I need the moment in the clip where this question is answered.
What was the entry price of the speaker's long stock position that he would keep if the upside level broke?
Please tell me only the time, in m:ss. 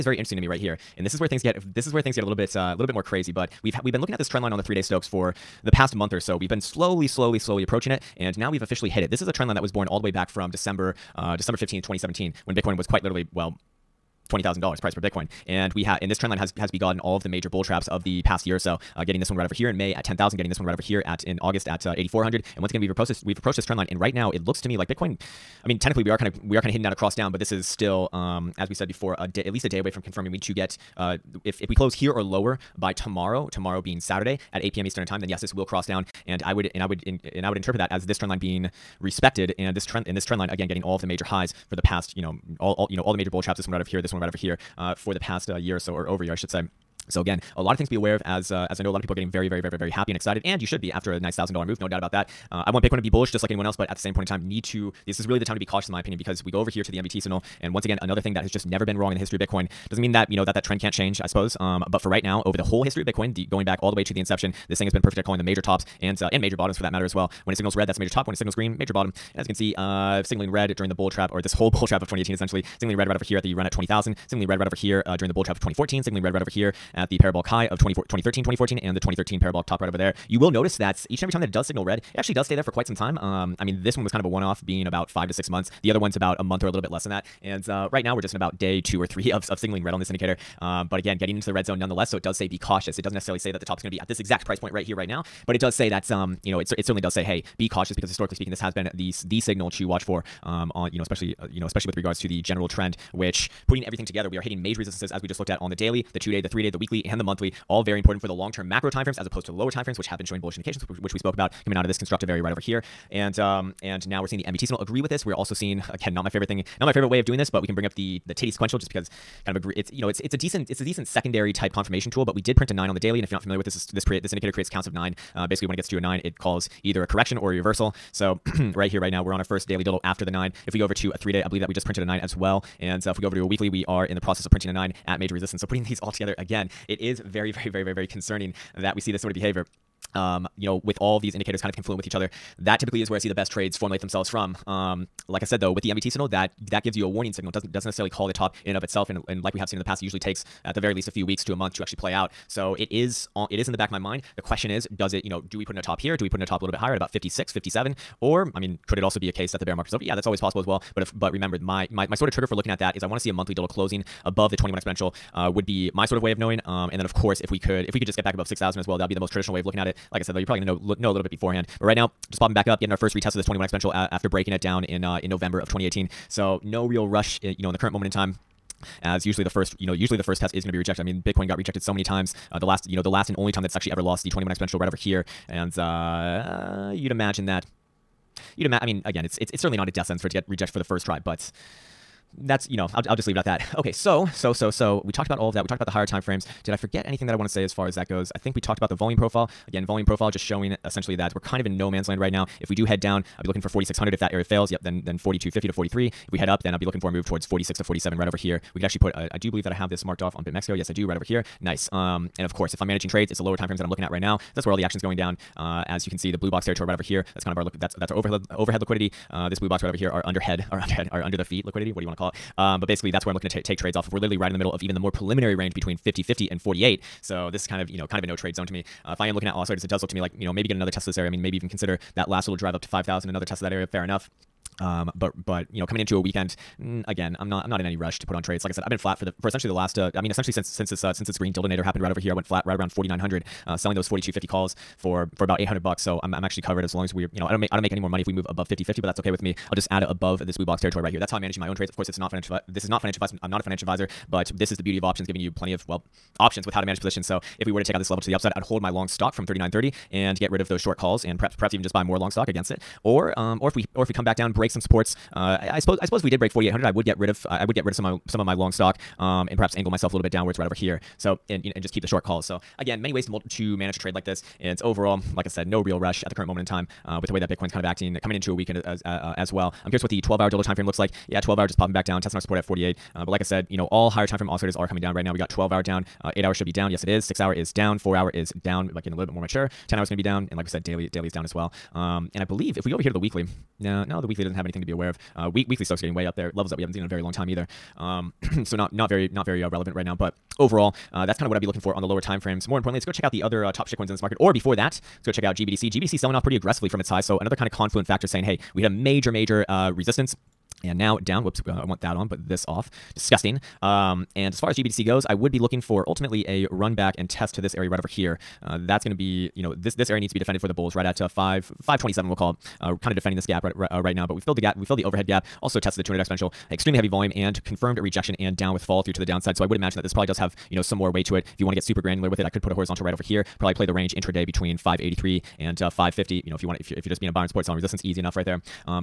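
4:19.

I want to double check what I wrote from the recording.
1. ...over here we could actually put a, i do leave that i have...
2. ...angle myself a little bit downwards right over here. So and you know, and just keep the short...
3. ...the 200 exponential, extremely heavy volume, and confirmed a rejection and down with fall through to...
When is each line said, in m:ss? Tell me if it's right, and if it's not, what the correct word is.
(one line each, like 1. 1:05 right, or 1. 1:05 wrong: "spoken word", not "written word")
1. 3:28 wrong: "believe", not "leave"
2. 4:29 right
3. 5:25 right.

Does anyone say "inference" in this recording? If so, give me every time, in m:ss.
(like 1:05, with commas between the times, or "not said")
not said.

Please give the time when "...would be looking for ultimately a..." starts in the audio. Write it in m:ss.
5:15.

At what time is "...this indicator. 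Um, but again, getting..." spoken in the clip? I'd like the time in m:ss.
1:29.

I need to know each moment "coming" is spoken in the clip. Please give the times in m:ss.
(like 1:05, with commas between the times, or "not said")
1:51, 3:55, 4:38, 4:44.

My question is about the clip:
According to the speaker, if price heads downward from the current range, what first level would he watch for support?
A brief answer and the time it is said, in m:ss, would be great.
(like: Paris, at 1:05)
4600, at 3:23.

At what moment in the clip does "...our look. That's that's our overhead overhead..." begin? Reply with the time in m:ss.
3:37.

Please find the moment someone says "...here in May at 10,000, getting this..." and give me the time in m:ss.
0:19.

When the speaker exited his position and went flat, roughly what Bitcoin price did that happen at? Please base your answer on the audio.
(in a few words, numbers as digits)
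4,900.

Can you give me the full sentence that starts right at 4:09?
I'll just add it above this blue box territory right here.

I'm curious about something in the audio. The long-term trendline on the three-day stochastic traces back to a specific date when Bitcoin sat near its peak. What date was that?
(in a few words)
December 15, 2017.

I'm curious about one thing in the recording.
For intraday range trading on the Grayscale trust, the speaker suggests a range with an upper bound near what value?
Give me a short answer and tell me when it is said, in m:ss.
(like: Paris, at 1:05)
583, at 5:34.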